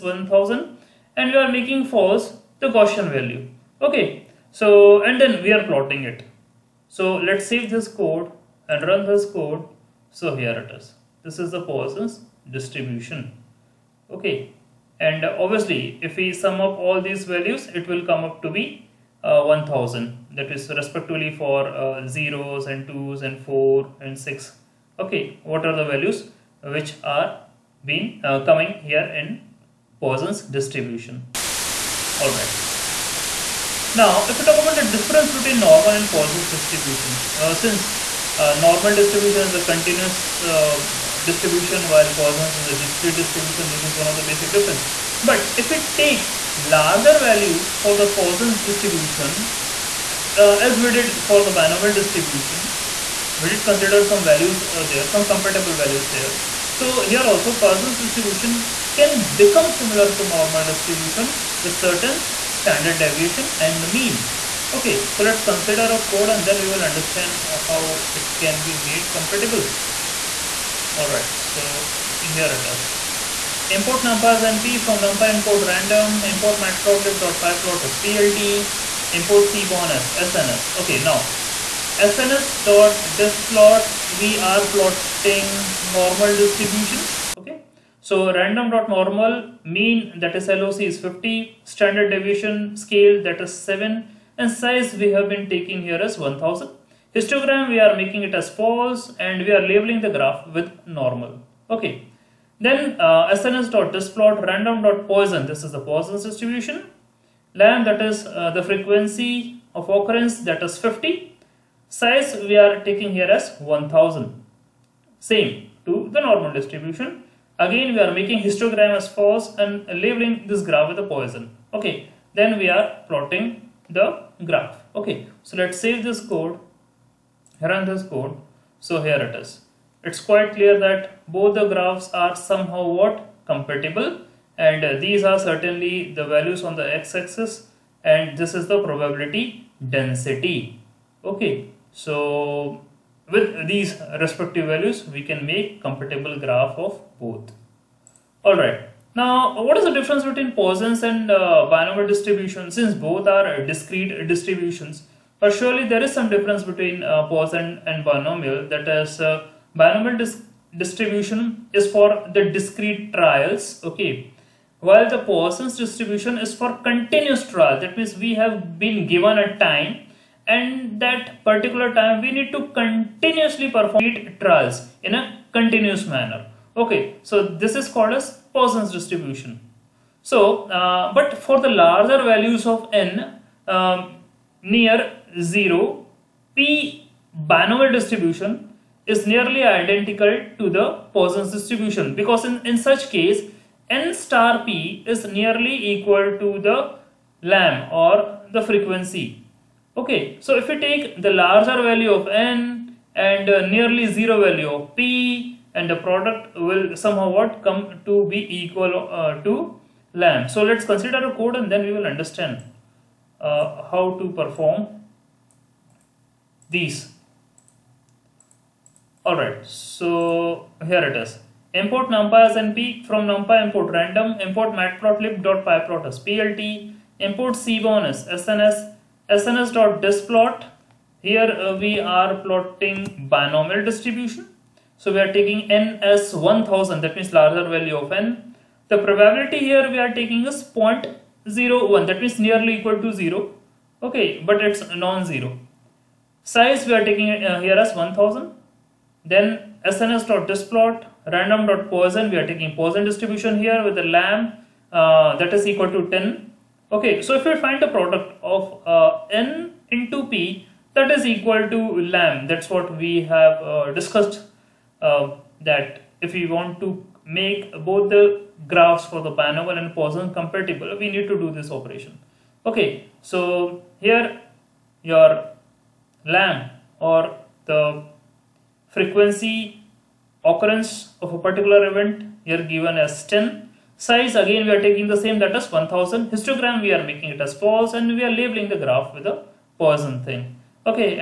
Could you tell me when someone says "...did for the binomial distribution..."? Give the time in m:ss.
0:50.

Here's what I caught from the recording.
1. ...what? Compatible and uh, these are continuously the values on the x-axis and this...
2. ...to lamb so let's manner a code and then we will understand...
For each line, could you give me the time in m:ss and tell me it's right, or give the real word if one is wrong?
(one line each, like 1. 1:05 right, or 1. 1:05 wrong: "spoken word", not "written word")
1. 2:12 wrong: "certainly", not "continuously"
2. 3:29 wrong: "consider", not "manner".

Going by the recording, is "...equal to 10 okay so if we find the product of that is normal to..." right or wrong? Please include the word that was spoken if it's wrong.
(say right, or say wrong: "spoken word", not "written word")
wrong: "equal", not "normal".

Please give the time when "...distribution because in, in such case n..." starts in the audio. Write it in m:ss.
3:11.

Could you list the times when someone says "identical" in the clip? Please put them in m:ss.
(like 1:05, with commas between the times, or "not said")
3:09.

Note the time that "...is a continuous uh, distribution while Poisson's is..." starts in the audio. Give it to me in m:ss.
0:39.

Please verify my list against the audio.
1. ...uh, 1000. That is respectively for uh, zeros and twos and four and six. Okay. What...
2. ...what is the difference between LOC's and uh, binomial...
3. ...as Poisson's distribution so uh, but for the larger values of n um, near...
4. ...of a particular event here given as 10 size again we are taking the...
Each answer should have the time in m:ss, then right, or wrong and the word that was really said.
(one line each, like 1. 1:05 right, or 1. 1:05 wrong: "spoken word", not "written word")
1. 0:19 right
2. 2:29 wrong: "Poisson", not "LOC"
3. 2:58 right
4. 4:41 right.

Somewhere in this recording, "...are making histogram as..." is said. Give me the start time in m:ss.
1:57.